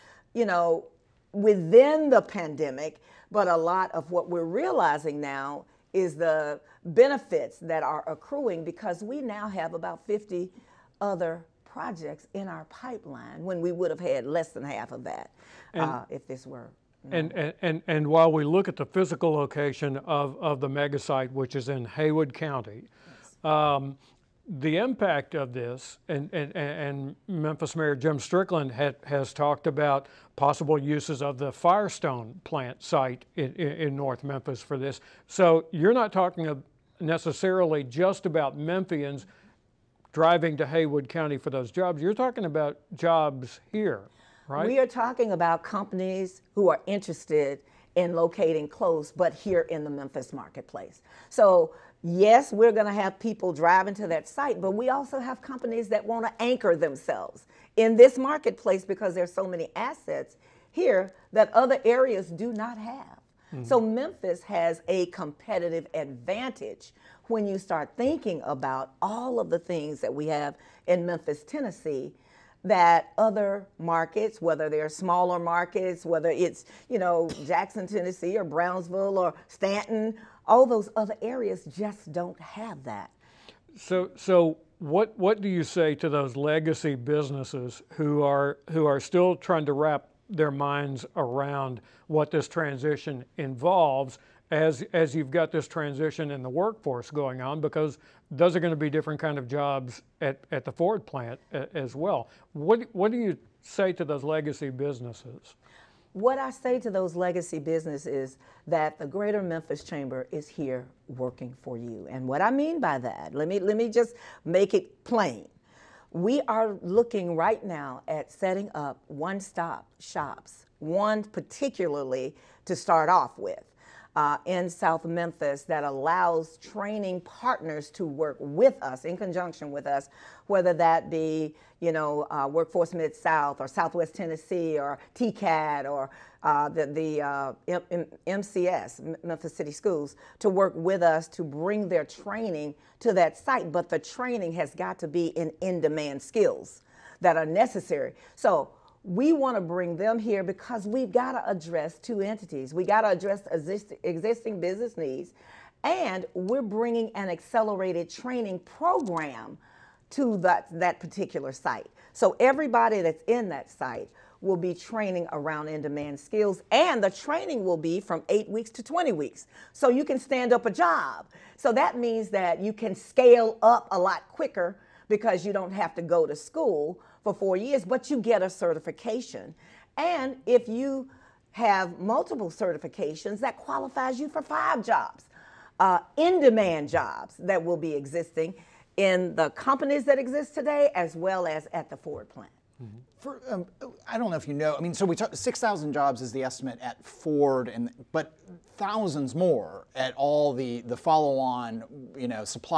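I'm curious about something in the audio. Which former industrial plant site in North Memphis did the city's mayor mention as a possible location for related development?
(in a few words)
Firestone plant.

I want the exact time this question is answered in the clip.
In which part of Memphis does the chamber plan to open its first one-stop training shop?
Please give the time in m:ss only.
2:04.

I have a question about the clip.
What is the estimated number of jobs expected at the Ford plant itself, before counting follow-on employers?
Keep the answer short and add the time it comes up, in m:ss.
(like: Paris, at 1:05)
6000, at 3:15.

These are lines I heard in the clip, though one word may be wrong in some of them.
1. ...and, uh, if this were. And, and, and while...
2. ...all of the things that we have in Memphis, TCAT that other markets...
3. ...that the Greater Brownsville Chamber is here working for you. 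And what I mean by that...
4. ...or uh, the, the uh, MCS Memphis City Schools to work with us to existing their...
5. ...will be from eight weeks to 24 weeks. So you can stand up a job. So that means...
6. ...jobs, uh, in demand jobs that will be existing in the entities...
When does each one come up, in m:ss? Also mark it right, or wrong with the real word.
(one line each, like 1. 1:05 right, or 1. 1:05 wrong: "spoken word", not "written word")
1. 0:15 right
2. 1:08 wrong: "Tennessee", not "TCAT"
3. 1:48 wrong: "Memphis", not "Brownsville"
4. 2:15 wrong: "bring", not "existing"
5. 2:47 wrong: "20", not "24"
6. 3:04 wrong: "companies", not "entities".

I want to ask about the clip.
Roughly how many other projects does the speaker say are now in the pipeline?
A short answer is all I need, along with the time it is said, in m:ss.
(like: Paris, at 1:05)
50, at 0:10.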